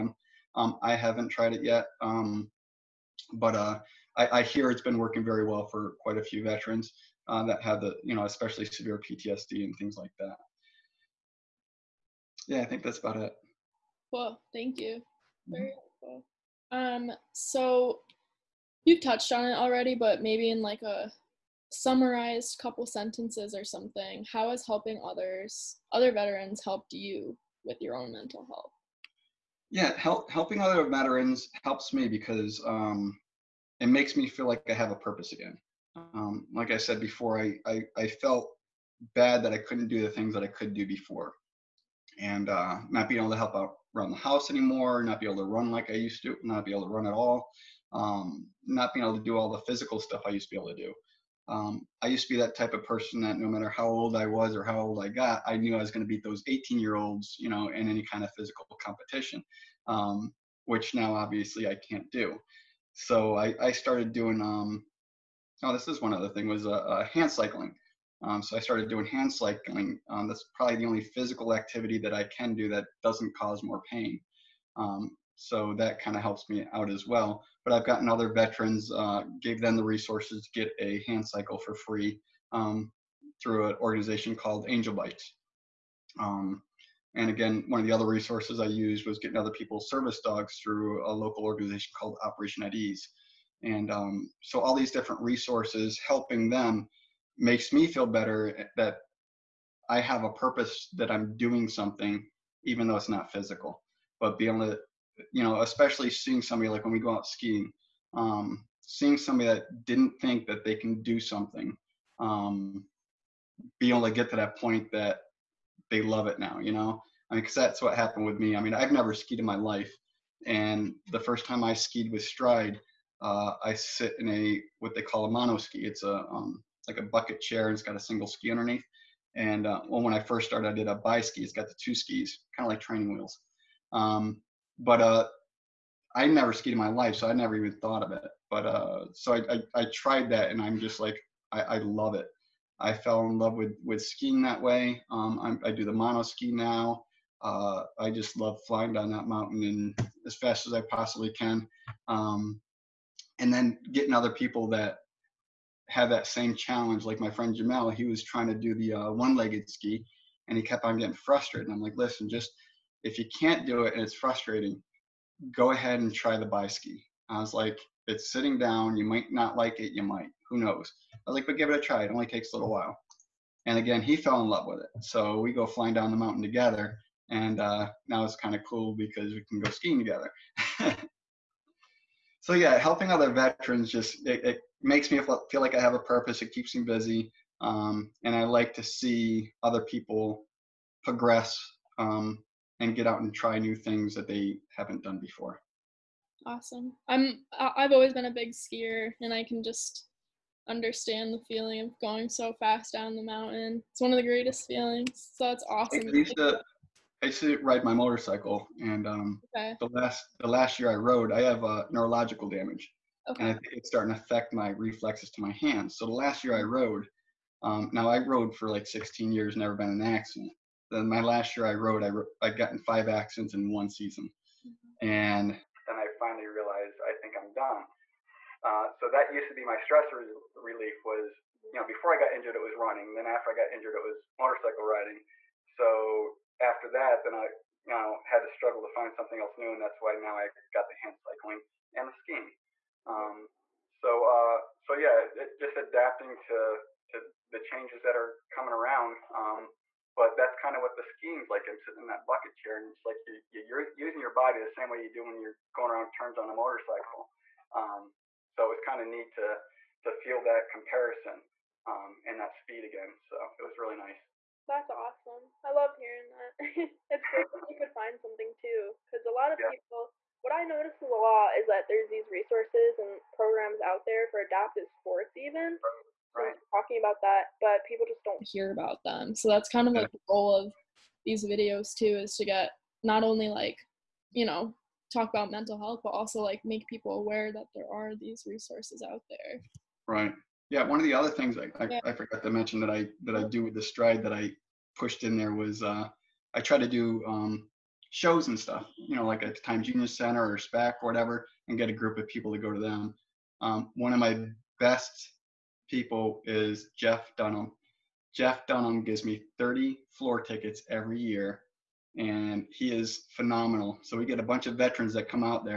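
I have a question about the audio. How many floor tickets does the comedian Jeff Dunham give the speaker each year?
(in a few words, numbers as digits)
30.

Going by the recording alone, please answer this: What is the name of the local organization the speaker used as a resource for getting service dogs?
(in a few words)
Operation at Ease.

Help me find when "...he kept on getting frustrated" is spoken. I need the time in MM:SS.
02:40.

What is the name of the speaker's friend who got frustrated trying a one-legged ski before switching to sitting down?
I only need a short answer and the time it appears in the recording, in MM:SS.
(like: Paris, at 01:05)
Jamel, at 02:37.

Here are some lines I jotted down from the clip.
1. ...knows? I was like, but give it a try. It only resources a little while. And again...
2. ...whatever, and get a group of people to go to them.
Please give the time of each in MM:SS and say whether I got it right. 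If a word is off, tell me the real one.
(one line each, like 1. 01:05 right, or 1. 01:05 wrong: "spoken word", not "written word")
1. 02:50 wrong: "takes", not "resources"
2. 05:01 right.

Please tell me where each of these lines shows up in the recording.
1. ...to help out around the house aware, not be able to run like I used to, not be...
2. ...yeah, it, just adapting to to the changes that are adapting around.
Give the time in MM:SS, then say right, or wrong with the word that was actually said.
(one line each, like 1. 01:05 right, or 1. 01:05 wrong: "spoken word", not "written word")
1. 00:43 wrong: "anymore", not "aware"
2. 04:04 wrong: "coming", not "adapting".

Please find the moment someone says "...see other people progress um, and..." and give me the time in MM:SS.
03:08.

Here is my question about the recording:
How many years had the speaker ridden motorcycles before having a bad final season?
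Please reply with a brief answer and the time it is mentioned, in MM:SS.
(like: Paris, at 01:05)
16, at 03:38.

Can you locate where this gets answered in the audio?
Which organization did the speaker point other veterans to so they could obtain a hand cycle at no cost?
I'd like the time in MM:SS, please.
01:24.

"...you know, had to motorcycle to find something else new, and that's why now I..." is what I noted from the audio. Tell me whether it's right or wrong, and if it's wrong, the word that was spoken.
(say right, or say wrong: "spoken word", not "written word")
wrong: "struggle", not "motorcycle".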